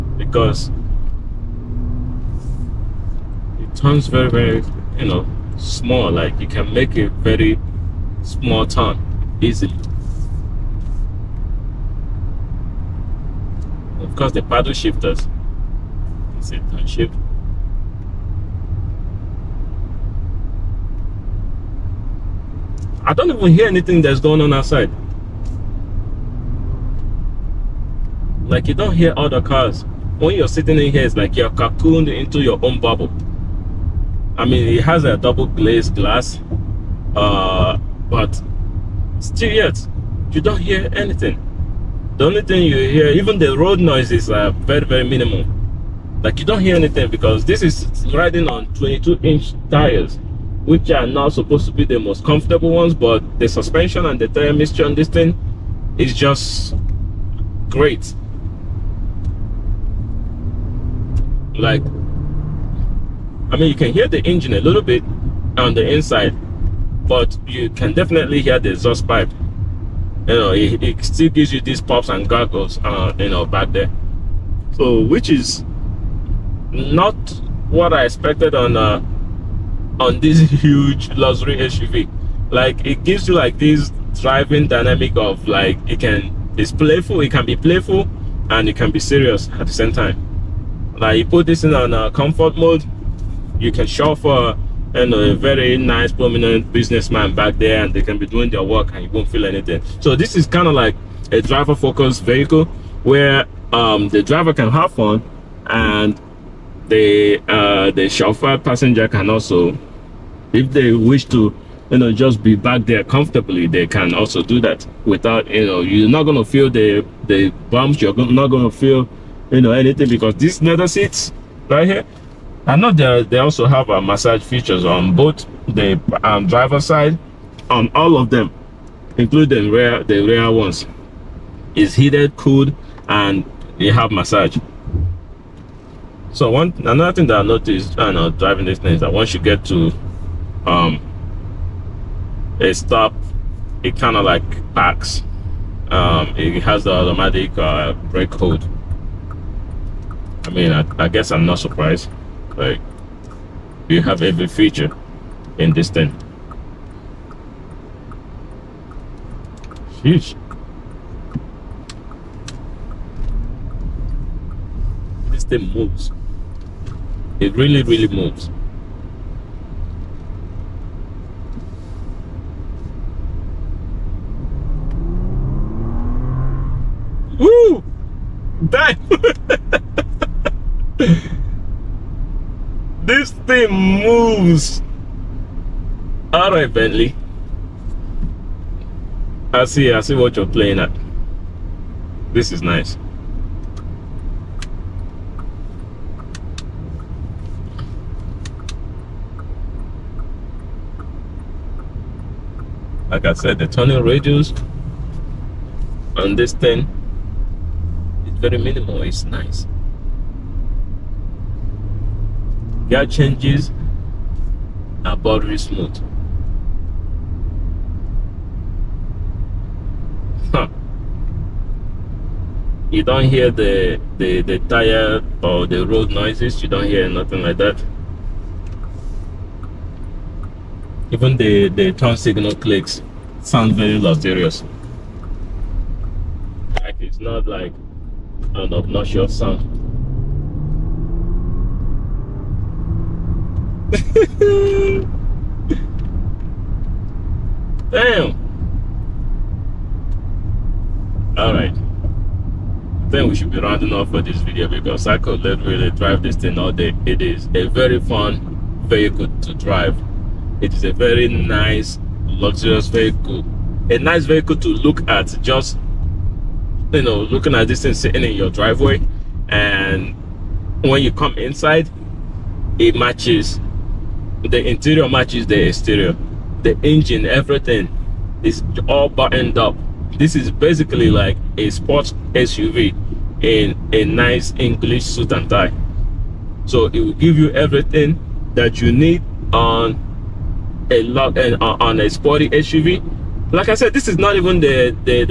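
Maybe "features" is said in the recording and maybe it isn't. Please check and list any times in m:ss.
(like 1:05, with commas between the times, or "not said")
2:04, 2:34.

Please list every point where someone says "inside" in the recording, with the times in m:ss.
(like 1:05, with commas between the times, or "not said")
1:05, 4:31.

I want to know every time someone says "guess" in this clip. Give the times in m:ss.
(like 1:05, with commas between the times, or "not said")
2:31.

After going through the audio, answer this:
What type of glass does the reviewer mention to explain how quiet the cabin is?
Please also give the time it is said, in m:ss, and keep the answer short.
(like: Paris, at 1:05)
double glazed, at 0:35.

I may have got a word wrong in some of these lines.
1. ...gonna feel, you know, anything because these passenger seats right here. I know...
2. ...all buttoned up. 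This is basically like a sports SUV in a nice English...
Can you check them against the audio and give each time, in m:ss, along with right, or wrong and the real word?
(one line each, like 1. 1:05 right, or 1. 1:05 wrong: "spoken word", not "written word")
1. 1:58 wrong: "leather", not "passenger"
2. 4:38 right.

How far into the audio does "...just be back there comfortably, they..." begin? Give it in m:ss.
1:52.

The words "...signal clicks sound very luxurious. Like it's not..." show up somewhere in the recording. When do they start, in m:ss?
3:52.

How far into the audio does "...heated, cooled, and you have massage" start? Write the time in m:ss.
2:11.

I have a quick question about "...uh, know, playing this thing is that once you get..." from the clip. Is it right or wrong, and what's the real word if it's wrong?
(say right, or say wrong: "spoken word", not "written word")
wrong: "driving", not "playing".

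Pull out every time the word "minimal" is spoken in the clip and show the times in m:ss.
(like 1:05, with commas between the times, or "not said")
0:45, 3:28.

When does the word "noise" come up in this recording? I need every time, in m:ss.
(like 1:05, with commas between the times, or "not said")
0:43, 3:46.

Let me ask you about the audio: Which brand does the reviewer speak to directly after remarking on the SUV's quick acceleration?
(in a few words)
Bentley.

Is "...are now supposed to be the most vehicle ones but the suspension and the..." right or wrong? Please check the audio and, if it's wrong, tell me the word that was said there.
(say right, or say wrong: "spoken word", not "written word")
wrong: "comfortable", not "vehicle".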